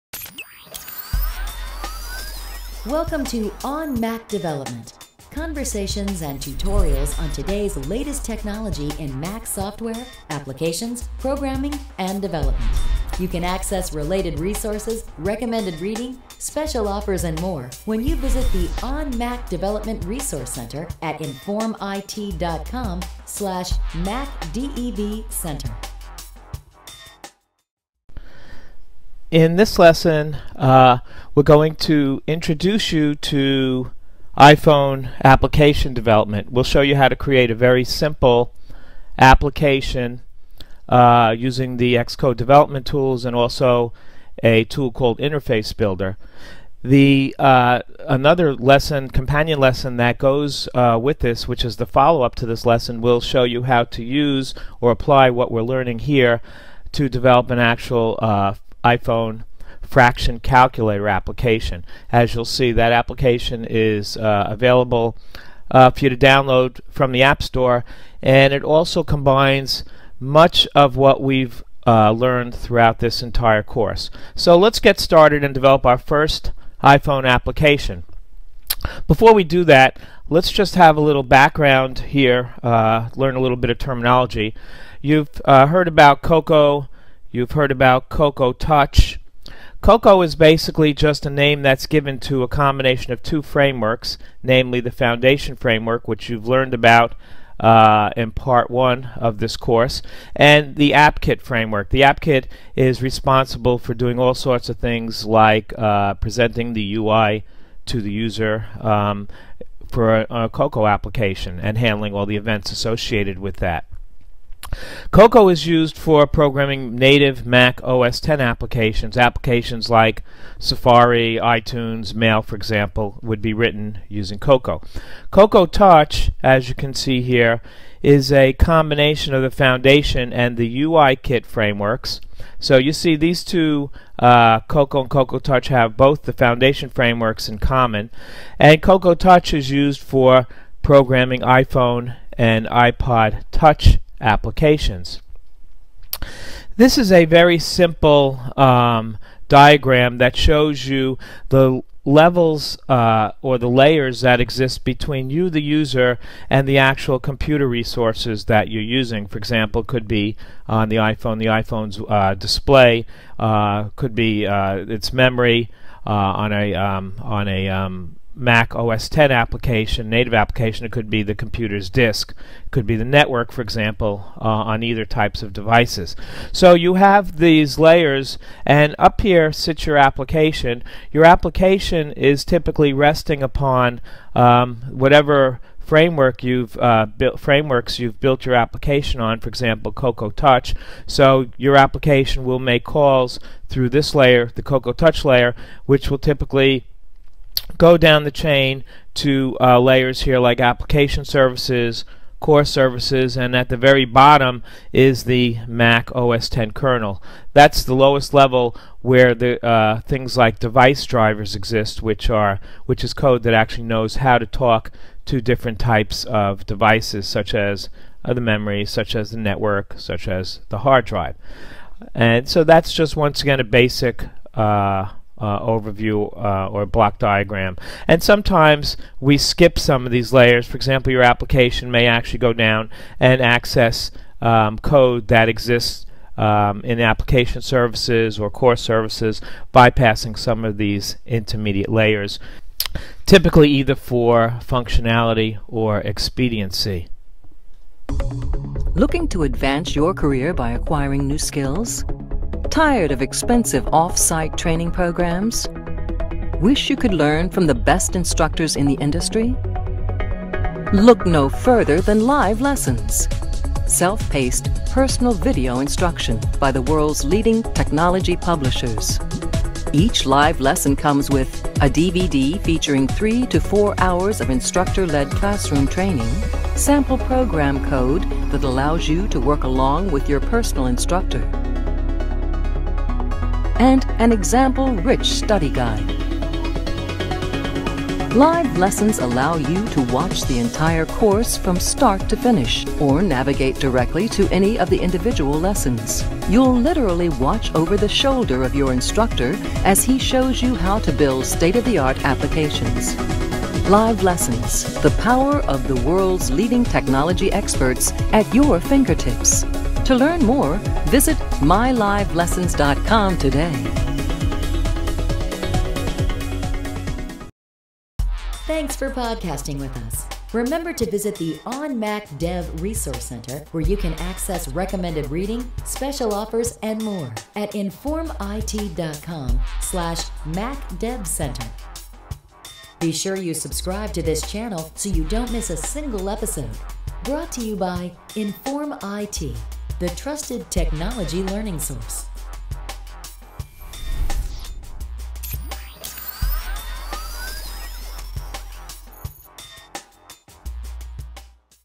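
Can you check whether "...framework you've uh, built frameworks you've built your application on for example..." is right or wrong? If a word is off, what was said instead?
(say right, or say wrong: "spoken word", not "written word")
right.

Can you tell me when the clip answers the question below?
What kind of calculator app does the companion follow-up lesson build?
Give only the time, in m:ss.
0:59.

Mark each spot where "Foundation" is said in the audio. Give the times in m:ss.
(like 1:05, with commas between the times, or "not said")
1:34, 2:09, 2:16.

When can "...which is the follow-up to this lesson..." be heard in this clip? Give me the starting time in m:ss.
0:51.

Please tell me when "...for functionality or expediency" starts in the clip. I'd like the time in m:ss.
4:03.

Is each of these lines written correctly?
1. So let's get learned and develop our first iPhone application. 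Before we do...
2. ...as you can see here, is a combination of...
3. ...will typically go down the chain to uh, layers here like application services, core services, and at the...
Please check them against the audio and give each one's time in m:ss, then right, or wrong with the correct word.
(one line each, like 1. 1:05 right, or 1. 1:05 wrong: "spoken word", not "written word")
1. 1:14 wrong: "started", not "learned"
2. 2:06 right
3. 3:16 right.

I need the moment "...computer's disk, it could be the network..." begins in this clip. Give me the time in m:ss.
2:51.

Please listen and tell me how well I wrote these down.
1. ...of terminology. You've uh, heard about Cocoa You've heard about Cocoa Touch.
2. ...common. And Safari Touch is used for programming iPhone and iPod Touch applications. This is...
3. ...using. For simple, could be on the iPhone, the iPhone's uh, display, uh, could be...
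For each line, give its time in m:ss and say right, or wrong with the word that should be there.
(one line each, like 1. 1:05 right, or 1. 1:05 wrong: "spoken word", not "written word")
1. 1:23 right
2. 2:17 wrong: "Cocoa", not "Safari"
3. 2:38 wrong: "example", not "simple".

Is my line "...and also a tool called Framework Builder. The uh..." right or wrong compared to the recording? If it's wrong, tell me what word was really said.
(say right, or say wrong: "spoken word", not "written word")
wrong: "Interface", not "Framework".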